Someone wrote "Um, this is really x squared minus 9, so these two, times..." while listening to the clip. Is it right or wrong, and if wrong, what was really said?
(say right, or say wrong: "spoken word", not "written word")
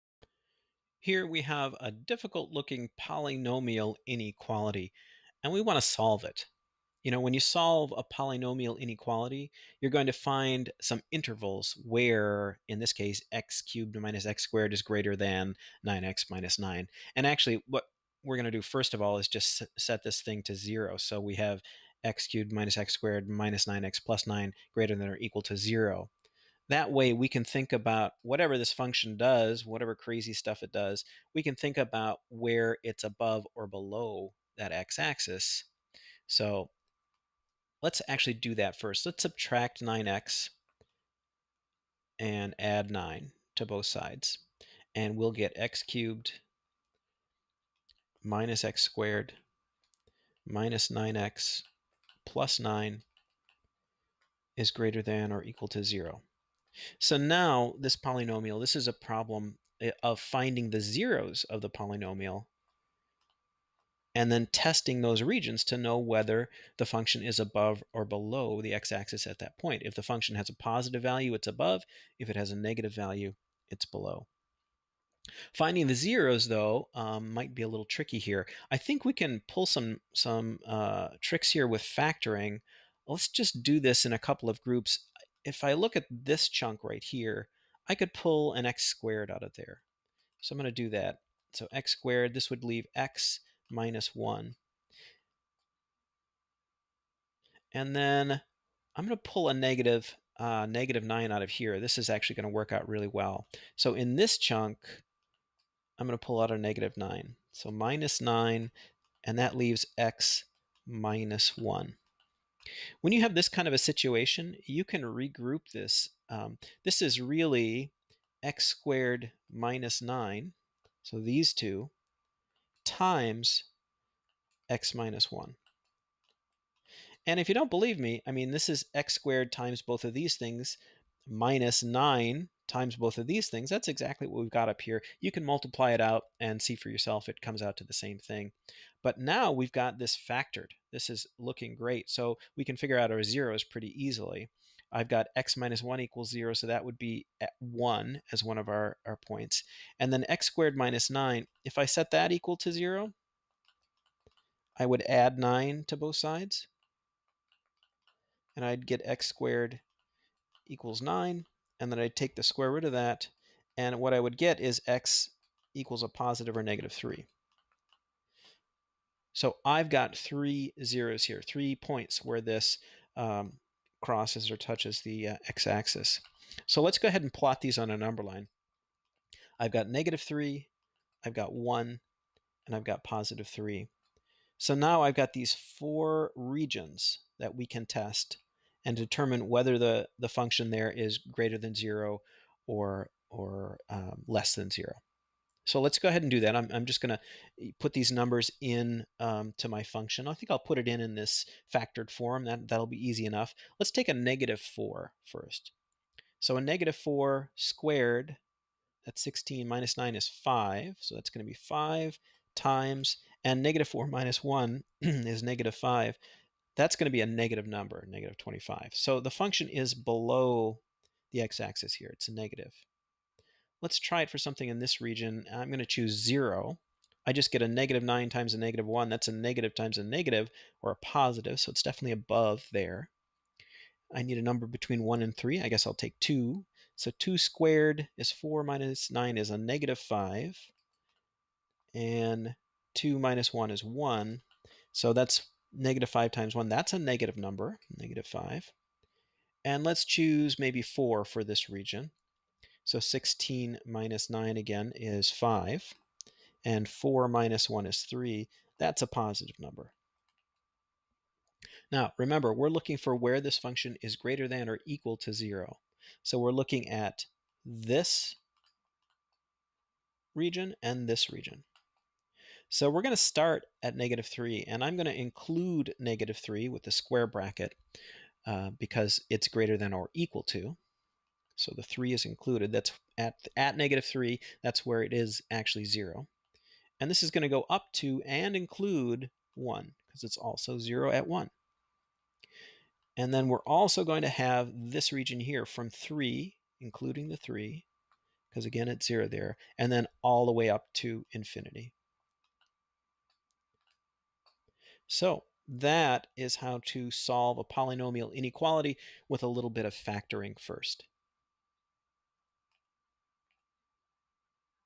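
right.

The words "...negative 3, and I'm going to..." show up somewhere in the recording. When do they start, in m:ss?
4:33.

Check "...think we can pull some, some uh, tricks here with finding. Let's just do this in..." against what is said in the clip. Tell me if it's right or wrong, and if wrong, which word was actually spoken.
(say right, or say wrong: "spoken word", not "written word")
wrong: "factoring", not "finding".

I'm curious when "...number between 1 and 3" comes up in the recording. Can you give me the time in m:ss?
3:54.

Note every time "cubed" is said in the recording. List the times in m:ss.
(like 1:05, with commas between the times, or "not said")
0:13, 0:22, 0:45.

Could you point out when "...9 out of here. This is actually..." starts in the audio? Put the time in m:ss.
1:41.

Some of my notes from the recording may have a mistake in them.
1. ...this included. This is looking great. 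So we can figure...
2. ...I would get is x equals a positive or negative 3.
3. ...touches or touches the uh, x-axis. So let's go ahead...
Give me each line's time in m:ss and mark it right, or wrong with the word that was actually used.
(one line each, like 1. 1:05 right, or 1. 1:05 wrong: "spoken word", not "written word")
1. 2:19 wrong: "factored", not "included"
2. 2:44 right
3. 2:54 wrong: "crosses", not "touches".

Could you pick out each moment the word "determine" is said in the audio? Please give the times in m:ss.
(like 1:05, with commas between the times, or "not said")
3:08.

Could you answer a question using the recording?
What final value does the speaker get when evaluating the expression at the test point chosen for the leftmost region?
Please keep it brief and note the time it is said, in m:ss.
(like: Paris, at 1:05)
-25, at 3:38.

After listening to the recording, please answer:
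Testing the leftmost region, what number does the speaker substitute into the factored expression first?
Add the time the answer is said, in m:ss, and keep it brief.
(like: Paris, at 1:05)
-4, at 3:23.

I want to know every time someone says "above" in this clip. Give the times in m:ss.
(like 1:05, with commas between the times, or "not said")
0:33, 1:07, 1:11, 3:52.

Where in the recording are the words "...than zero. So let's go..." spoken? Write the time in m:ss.
3:14.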